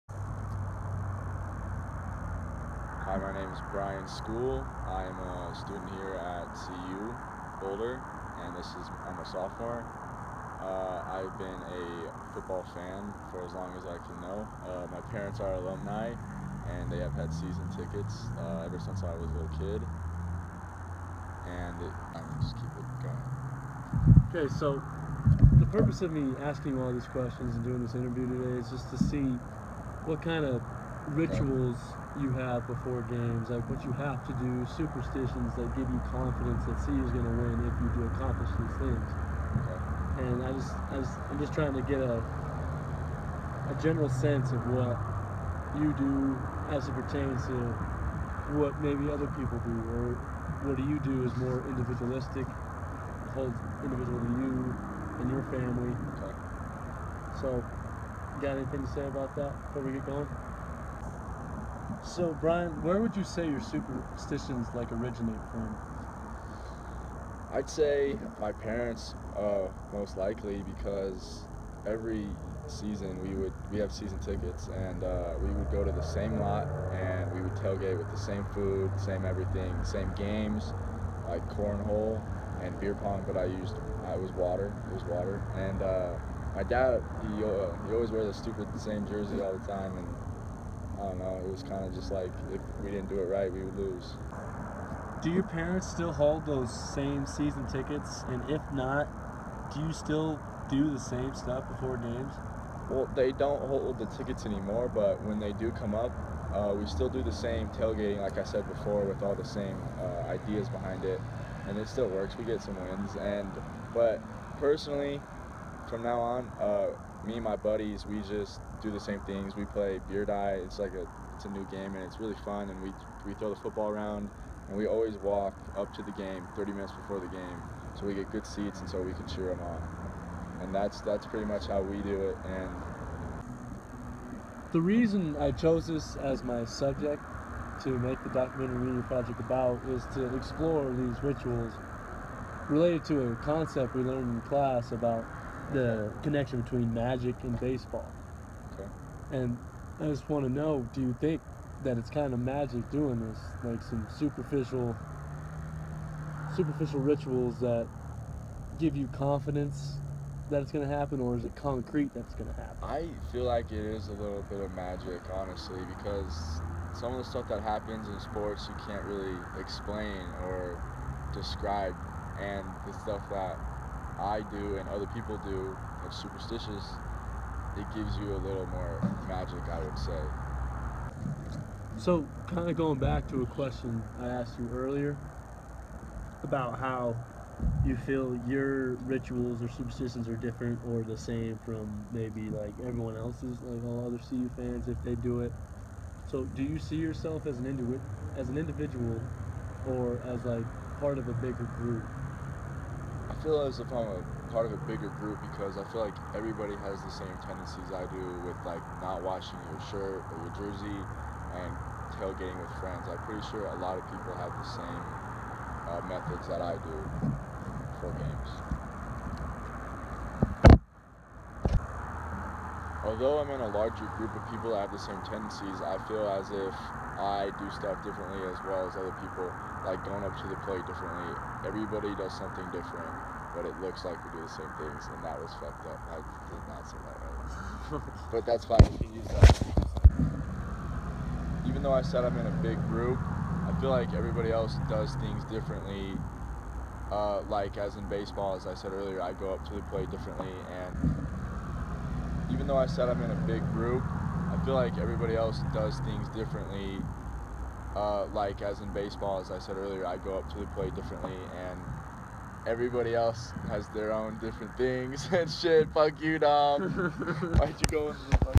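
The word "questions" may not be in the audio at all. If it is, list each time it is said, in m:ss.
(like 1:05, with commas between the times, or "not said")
0:27, 3:03.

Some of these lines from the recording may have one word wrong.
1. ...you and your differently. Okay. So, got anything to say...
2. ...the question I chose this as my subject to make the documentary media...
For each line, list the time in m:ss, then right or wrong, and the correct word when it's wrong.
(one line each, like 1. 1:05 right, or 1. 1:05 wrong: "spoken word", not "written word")
1. 0:54 wrong: "family", not "differently"
2. 2:14 wrong: "reason", not "question".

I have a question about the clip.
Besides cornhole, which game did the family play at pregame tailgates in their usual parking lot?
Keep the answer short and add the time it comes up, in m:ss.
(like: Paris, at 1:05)
Beer pong, at 1:22.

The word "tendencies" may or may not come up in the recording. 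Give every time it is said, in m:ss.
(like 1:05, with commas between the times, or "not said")
3:27, 3:45.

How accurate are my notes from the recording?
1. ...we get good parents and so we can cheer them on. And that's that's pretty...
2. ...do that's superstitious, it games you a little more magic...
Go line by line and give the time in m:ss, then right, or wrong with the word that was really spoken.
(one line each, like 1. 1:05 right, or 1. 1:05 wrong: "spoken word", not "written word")
1. 2:08 wrong: "seats", not "parents"
2. 2:55 wrong: "gives", not "games".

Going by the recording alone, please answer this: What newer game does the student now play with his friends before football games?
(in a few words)
Beer die.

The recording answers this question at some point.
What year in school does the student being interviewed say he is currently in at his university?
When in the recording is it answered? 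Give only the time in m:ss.
0:09.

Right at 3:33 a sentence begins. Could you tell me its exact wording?
I'm pretty sure a lot of people have the same uh, methods that I do for games.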